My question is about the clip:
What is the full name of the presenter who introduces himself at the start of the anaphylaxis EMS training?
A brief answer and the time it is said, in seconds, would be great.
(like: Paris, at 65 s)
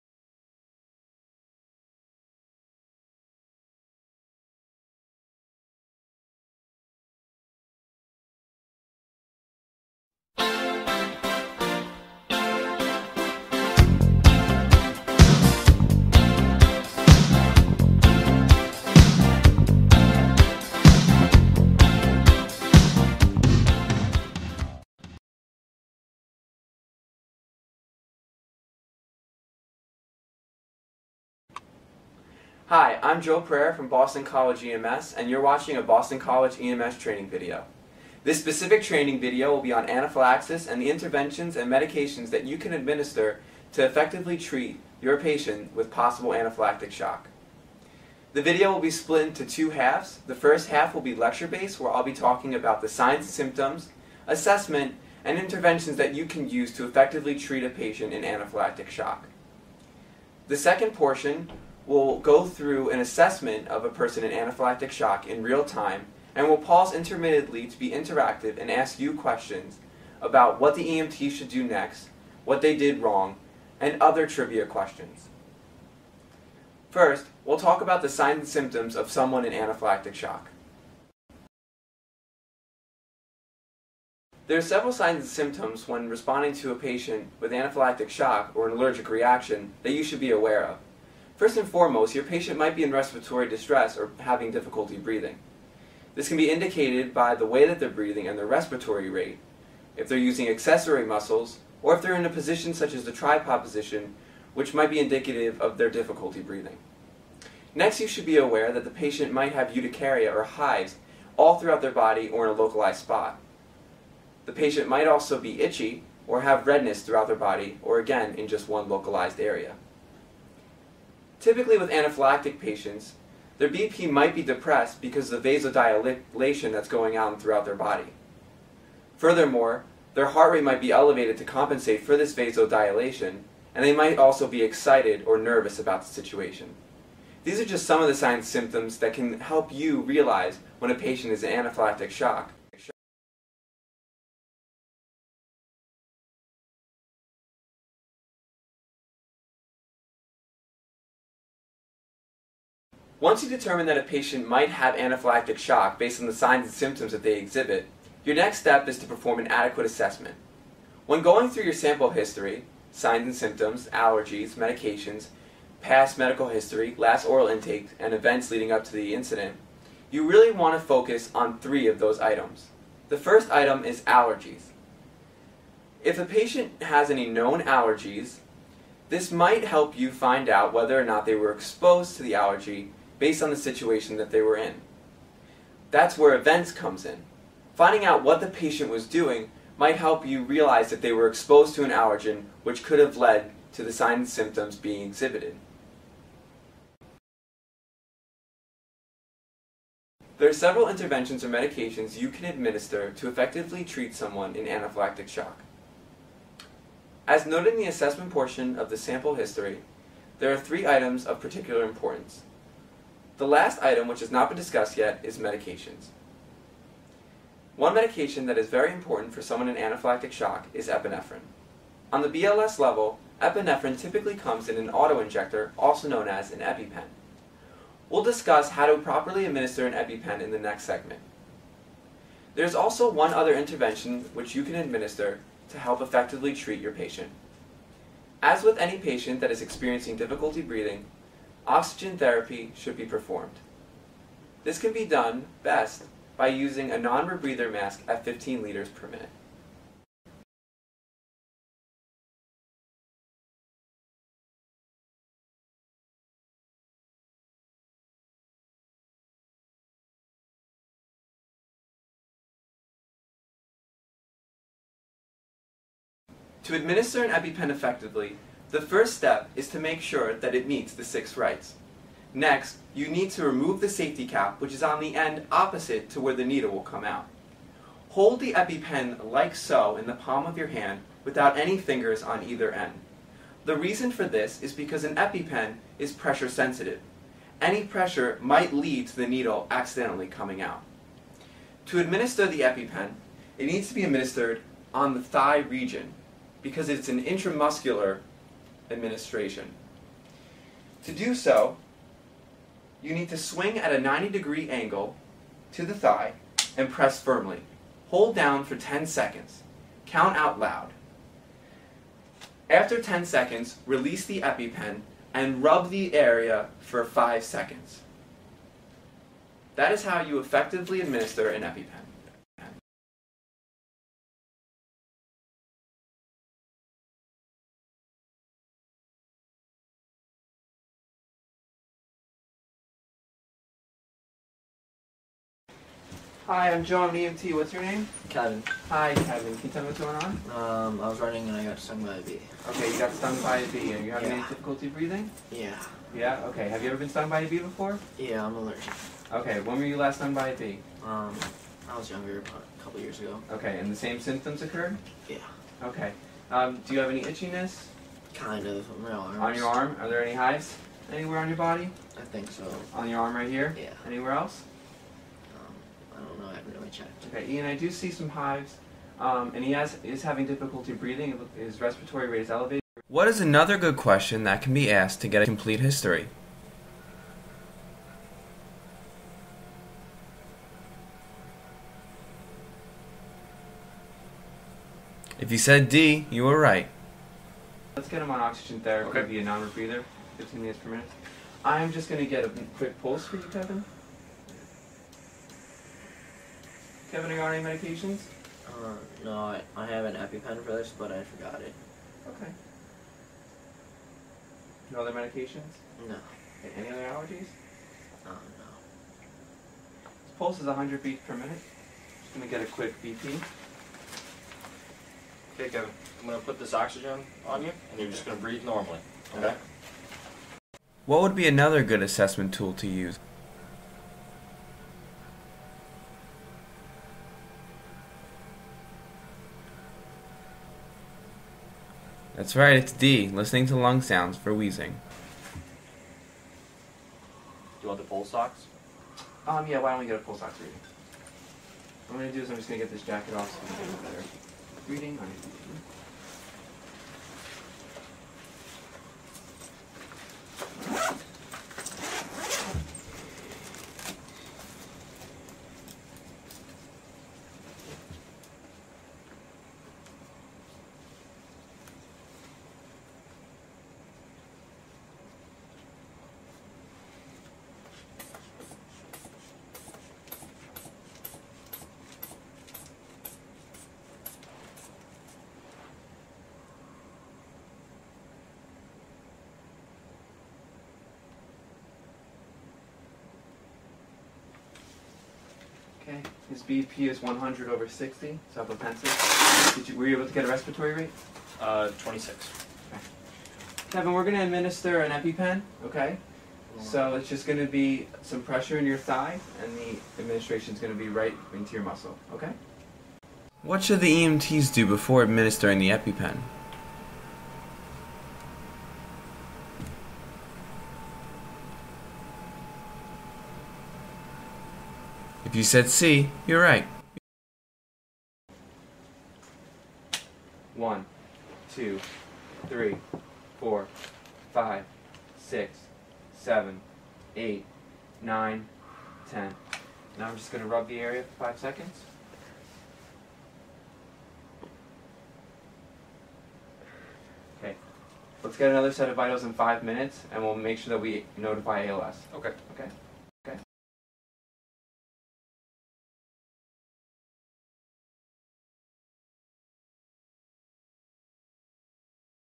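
Joe Prayer, at 33 s.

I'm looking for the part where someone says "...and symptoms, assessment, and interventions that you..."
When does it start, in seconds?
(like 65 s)
53 s.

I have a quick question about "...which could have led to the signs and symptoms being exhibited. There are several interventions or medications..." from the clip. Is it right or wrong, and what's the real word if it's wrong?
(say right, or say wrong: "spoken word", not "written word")
right.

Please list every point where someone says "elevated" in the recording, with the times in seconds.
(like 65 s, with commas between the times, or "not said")
130 s, 372 s.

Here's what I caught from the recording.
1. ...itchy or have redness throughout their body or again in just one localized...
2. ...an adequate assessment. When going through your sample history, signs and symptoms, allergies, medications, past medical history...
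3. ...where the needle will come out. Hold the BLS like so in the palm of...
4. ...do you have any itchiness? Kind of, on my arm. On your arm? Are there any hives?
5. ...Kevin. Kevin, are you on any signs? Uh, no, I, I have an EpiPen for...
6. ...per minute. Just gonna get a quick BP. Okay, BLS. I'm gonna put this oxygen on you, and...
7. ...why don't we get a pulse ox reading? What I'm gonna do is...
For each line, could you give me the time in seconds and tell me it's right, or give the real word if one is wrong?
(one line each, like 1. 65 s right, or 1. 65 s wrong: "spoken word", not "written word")
1. 115 s right
2. 159 s right
3. 276 s wrong: "EpiPen", not "BLS"
4. 356 s right
5. 393 s wrong: "medications", not "signs"
6. 411 s wrong: "Kevin", not "BLS"
7. 439 s right.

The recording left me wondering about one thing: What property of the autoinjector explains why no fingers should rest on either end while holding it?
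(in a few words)
pressure sensitive.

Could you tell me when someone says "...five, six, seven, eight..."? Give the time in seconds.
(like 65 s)
524 s.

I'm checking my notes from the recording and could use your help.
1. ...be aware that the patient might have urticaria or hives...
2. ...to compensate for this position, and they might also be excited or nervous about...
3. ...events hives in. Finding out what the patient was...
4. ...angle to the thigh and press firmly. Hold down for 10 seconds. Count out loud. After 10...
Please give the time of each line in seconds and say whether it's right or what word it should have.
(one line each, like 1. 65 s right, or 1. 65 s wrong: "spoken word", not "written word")
1. 108 s right
2. 131 s wrong: "vasodilation", not "position"
3. 186 s wrong: "comes", not "hives"
4. 304 s right.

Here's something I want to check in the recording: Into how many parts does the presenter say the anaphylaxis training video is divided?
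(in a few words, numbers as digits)
2.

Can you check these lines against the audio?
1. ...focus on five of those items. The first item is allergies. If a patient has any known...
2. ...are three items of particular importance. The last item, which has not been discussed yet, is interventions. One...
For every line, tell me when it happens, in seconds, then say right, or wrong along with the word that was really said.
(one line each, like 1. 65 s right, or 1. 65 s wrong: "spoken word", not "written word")
1. 170 s wrong: "three", not "five"
2. 210 s wrong: "medications", not "interventions".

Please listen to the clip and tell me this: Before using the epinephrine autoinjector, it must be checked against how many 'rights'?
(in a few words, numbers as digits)
6.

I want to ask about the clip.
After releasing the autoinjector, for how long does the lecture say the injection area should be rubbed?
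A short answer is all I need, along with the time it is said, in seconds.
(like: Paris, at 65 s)
5 seconds, at 317 s.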